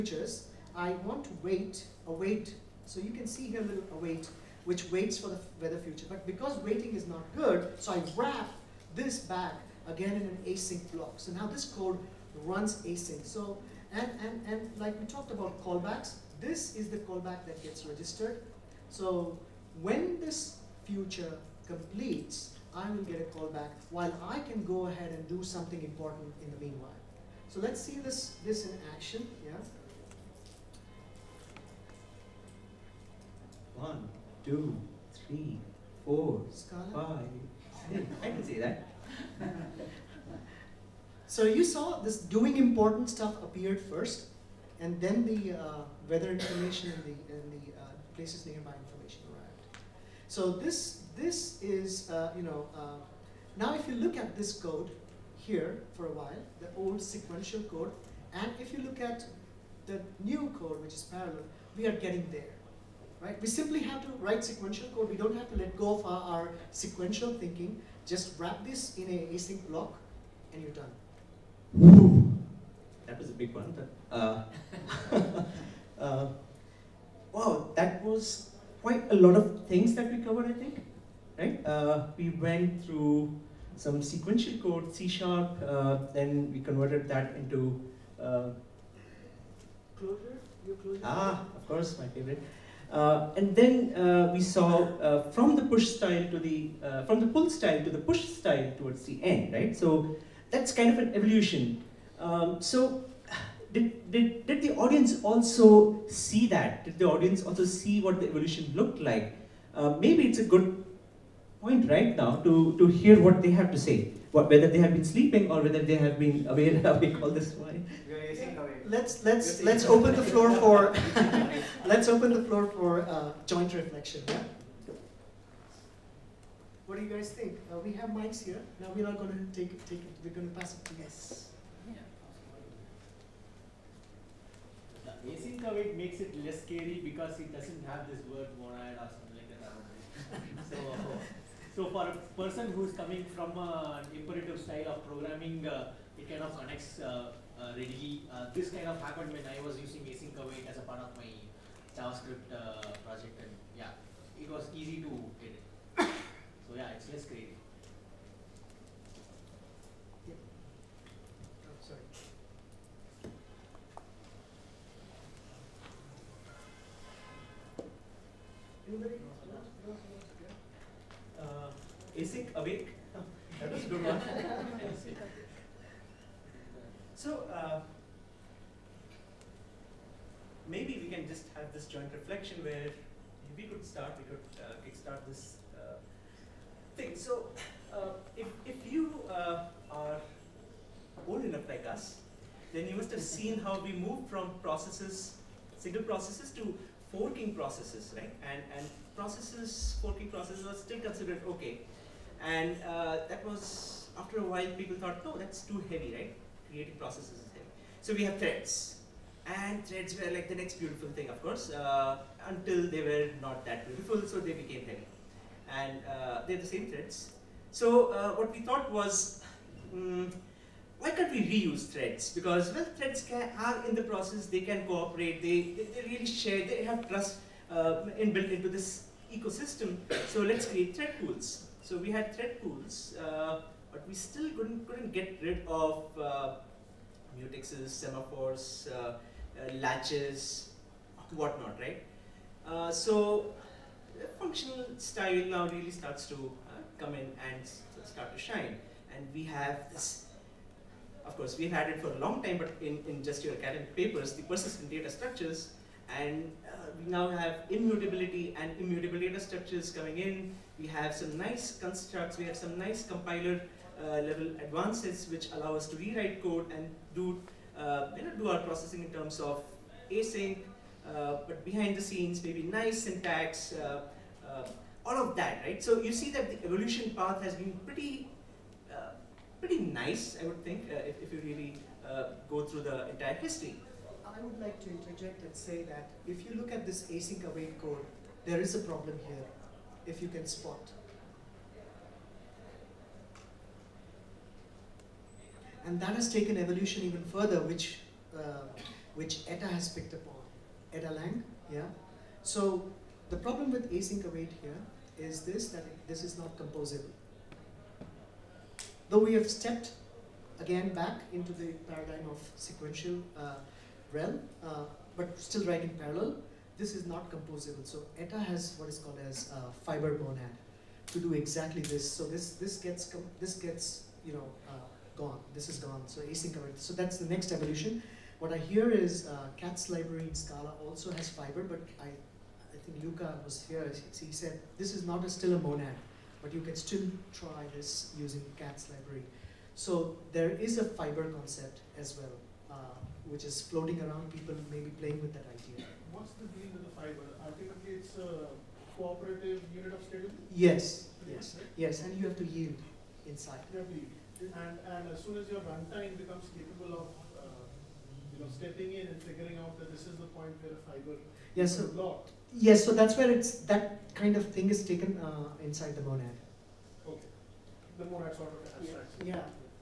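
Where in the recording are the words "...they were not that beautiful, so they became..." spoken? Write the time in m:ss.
3:32.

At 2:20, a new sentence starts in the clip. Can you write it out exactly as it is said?
so, so for a person who's coming from an imperative style of programming.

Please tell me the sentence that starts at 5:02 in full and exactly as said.
So the problem with async await here is this, that this is not composable.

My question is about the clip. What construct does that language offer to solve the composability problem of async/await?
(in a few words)
Fiber monad.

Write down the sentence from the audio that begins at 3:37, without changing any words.
So uh, what we thought was, um, why can't we reuse threads?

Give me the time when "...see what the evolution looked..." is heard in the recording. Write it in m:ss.
1:47.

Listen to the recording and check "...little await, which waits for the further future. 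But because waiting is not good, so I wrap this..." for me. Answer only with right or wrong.
wrong.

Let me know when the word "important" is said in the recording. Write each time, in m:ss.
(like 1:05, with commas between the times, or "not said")
0:25, 0:42.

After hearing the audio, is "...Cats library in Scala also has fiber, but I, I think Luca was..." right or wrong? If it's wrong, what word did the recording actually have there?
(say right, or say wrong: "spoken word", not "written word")
right.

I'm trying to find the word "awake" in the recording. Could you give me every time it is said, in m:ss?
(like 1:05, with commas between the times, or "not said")
1:56, 2:52.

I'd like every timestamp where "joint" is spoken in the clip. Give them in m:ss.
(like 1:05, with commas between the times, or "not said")
2:03, 3:01.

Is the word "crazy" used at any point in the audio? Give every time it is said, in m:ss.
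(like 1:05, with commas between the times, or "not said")
2:37.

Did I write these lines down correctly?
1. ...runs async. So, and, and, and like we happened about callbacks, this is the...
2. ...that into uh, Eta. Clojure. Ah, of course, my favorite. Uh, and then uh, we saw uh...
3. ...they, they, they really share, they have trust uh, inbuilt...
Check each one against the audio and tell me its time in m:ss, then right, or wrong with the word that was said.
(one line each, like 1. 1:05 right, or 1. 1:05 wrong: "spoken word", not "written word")
1. 0:12 wrong: "talked", not "happened"
2. 1:27 wrong: "Clojure", not "Eta"
3. 3:45 right.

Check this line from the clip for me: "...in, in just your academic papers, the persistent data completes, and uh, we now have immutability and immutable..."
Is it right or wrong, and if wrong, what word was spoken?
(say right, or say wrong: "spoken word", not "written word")
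wrong: "structures", not "completes".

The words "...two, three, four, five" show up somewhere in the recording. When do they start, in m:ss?
0:34.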